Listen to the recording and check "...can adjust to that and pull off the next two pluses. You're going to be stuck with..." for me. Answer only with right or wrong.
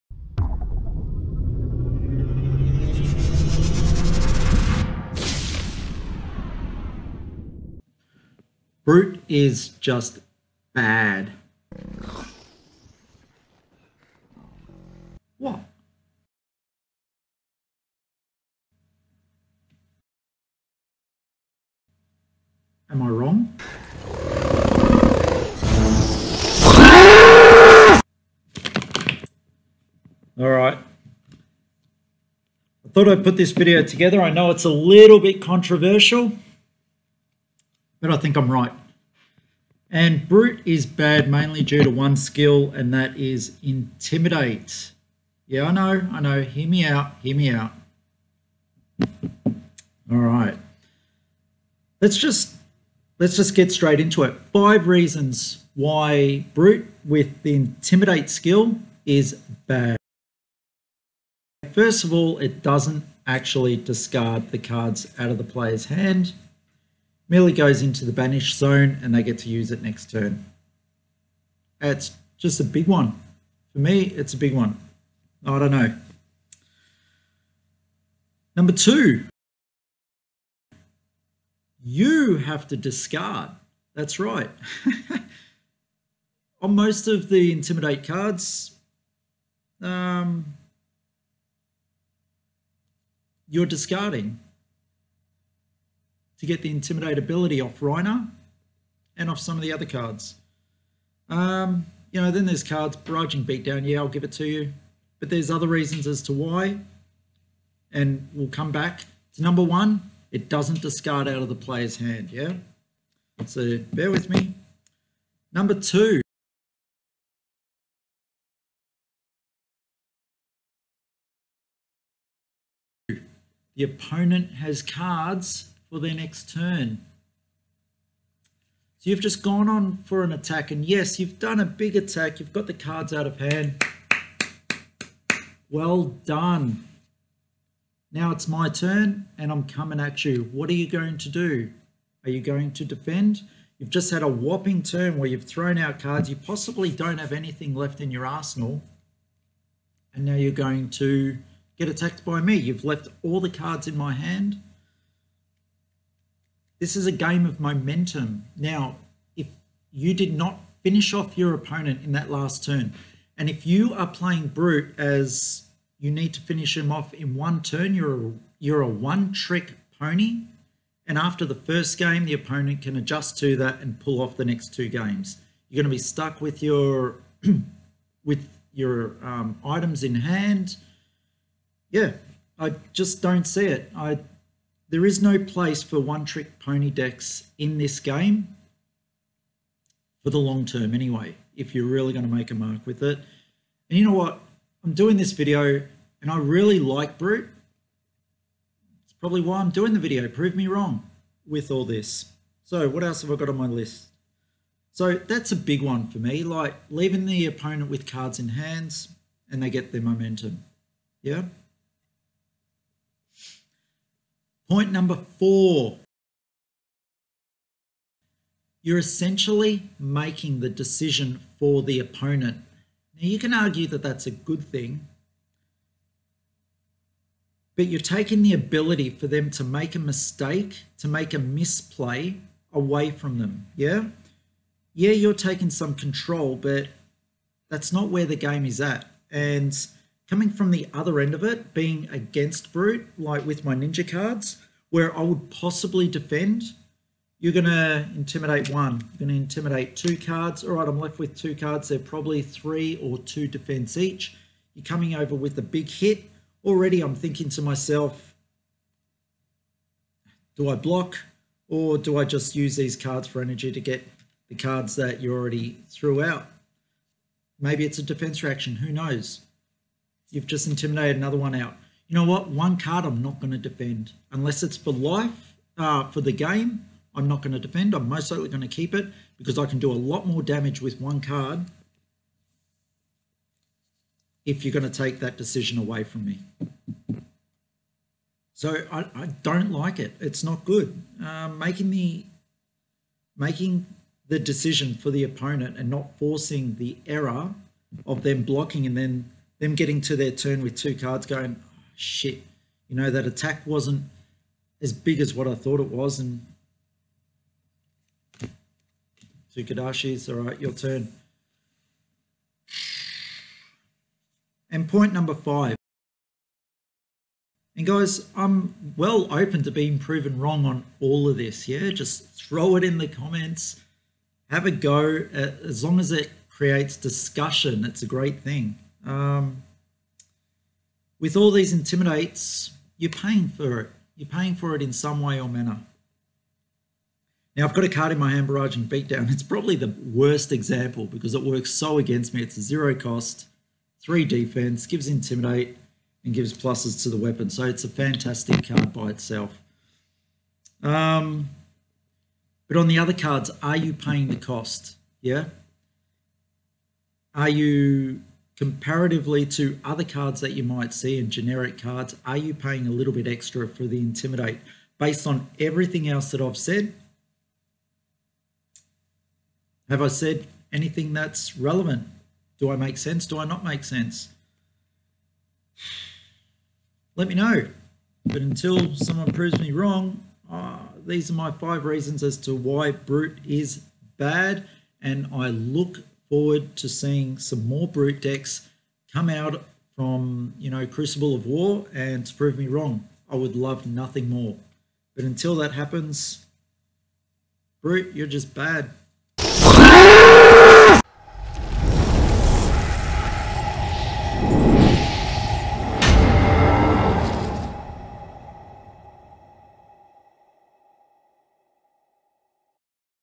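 wrong.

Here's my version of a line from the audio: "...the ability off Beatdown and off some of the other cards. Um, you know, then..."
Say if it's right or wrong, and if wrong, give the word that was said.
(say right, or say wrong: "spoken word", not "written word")
wrong: "Rhinar", not "Beatdown".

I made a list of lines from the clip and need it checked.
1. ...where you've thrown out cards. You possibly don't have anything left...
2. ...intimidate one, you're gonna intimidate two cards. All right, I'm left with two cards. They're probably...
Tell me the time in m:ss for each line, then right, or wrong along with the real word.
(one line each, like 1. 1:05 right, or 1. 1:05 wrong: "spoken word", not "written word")
1. 2:25 right
2. 4:08 right.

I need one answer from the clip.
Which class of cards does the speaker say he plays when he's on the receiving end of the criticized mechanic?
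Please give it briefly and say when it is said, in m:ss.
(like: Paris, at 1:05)
ninja, at 4:03.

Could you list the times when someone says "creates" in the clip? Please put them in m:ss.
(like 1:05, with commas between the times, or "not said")
5:26.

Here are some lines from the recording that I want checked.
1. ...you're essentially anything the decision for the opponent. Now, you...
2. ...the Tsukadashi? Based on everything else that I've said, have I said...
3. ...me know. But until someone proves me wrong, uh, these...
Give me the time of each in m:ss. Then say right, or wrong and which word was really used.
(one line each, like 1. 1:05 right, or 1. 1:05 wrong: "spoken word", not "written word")
1. 3:38 wrong: "making", not "anything"
2. 6:03 wrong: "Intimidate", not "Tsukadashi"
3. 6:17 right.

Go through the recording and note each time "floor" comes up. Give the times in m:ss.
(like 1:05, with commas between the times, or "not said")
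not said.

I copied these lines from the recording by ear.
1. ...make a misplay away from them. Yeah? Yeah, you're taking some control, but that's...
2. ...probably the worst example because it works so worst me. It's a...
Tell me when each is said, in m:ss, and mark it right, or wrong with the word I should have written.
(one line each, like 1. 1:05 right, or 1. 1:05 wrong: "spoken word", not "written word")
1. 3:51 right
2. 5:39 wrong: "against", not "worst".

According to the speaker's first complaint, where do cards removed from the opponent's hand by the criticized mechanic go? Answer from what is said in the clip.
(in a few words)
banish zone.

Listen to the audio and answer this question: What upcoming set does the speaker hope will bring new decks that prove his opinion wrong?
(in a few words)
Crucible of War.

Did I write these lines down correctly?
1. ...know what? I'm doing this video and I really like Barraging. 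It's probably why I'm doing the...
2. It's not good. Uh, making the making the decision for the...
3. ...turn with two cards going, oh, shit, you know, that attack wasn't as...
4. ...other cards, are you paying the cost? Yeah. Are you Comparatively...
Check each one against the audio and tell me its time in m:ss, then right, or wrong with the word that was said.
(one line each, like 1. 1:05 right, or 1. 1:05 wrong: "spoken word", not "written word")
1. 3:14 wrong: "Brute", not "Barraging"
2. 4:50 right
3. 5:00 right
4. 5:52 right.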